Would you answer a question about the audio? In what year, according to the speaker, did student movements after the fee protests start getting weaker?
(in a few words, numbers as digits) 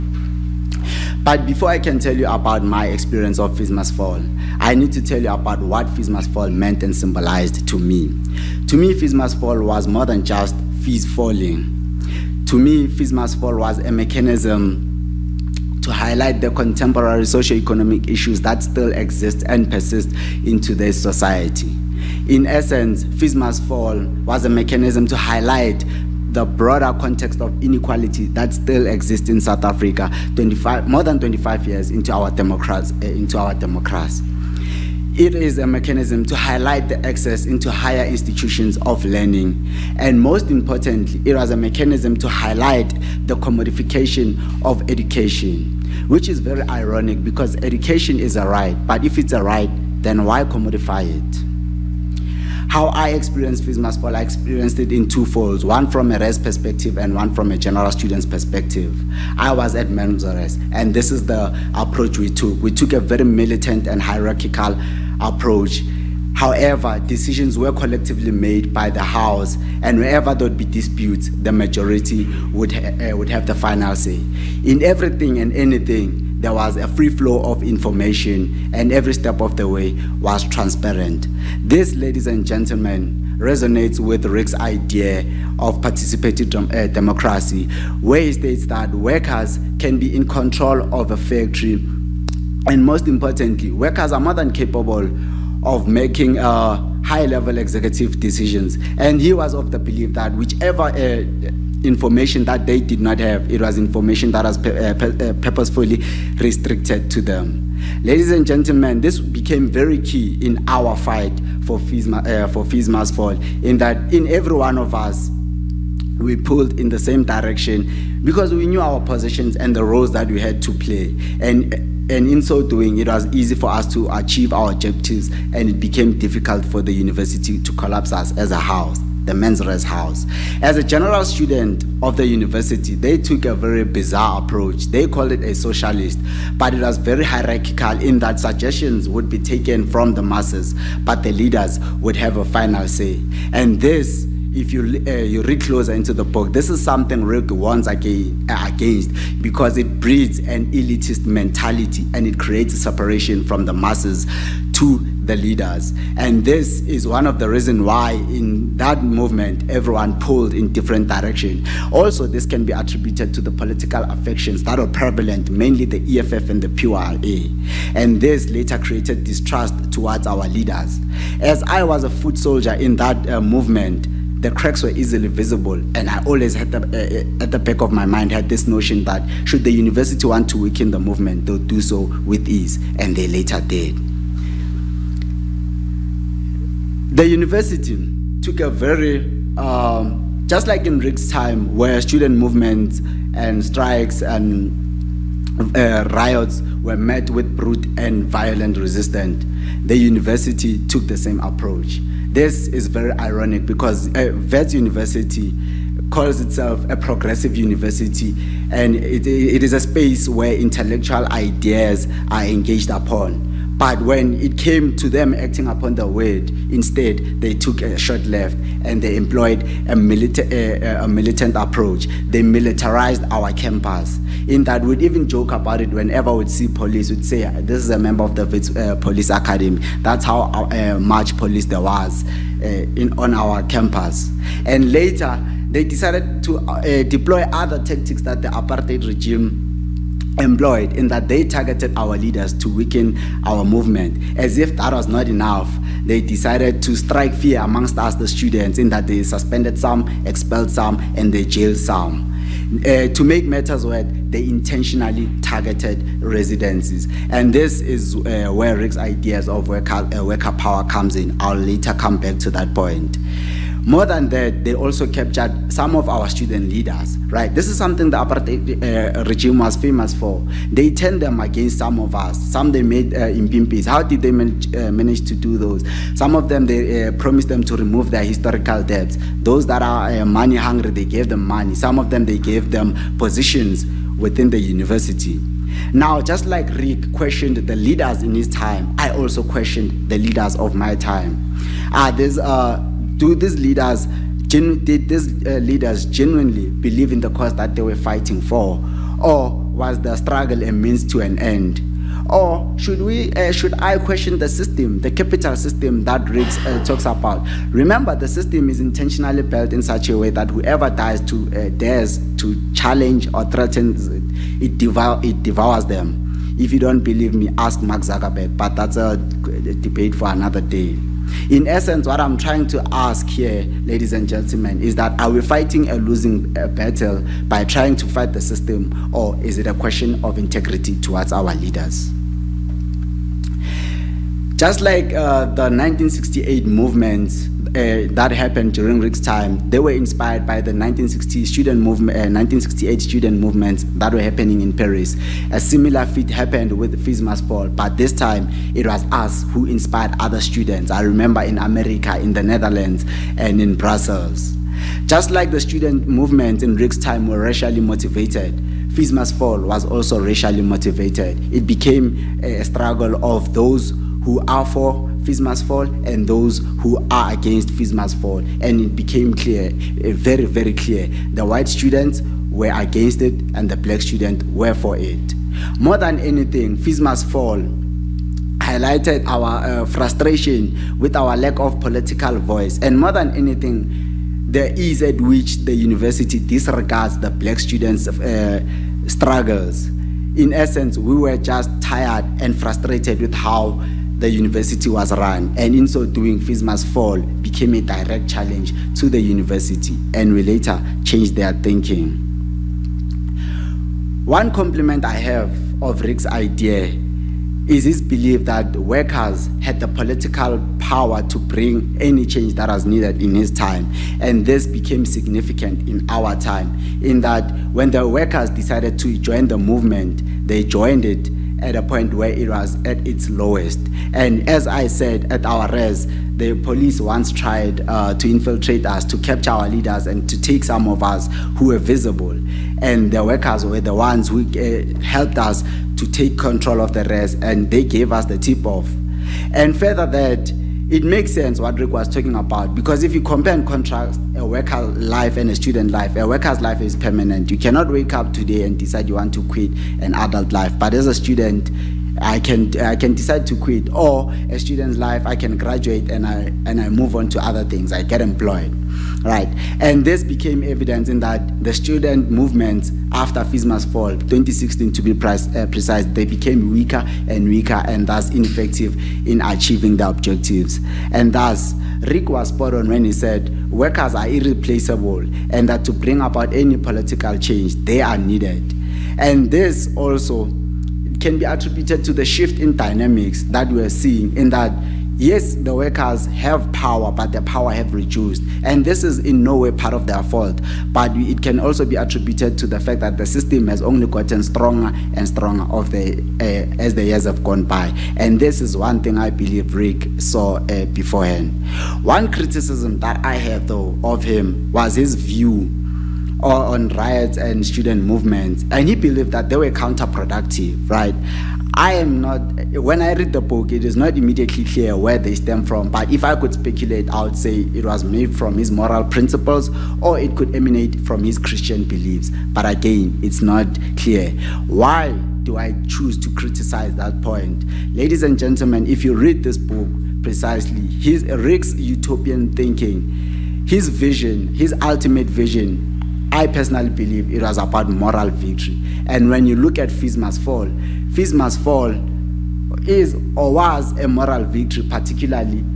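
2016.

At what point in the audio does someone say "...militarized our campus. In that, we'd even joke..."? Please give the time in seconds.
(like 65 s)
222 s.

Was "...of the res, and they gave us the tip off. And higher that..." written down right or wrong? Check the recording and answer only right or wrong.
wrong.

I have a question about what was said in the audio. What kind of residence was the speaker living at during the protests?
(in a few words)
Men's Res.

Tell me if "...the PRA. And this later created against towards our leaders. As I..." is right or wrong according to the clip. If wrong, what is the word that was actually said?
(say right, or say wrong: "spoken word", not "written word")
wrong: "distrust", not "against".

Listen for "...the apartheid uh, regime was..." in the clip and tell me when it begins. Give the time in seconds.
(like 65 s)
268 s.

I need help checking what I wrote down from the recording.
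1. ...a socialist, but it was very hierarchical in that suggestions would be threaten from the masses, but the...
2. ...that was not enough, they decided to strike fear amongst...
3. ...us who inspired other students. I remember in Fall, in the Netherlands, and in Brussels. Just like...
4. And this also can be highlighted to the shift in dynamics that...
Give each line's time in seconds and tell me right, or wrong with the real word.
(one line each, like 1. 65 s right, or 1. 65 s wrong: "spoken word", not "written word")
1. 135 s wrong: "taken", not "threaten"
2. 244 s right
3. 349 s wrong: "America", not "Fall"
4. 479 s wrong: "attributed", not "highlighted".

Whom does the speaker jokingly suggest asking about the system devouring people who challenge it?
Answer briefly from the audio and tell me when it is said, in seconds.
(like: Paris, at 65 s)
Mark Zuckerberg, at 317 s.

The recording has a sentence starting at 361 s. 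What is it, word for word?
It became a struggle of those who are for Fees Must fall and those who are against Fees Must fall.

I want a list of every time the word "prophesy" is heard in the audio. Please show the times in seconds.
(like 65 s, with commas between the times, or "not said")
not said.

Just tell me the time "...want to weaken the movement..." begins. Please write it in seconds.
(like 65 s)
180 s.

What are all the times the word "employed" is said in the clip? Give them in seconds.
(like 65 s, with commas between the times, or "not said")
219 s, 240 s, 458 s.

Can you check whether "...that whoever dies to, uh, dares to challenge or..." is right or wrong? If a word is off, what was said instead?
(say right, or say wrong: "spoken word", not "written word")
right.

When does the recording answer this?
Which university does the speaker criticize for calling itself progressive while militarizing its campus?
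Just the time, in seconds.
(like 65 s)
204 s.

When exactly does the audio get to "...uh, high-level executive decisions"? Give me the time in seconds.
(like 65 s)
96 s.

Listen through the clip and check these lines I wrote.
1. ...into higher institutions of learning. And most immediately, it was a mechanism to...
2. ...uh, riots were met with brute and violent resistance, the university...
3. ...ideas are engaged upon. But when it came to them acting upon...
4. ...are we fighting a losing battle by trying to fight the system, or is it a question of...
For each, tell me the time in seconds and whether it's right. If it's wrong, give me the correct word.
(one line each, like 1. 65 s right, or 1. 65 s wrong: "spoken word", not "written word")
1. 37 s wrong: "importantly", not "immediately"
2. 195 s right
3. 211 s right
4. 325 s right.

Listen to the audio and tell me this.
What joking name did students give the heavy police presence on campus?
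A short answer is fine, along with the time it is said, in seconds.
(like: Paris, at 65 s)
Police Academy, at 228 s.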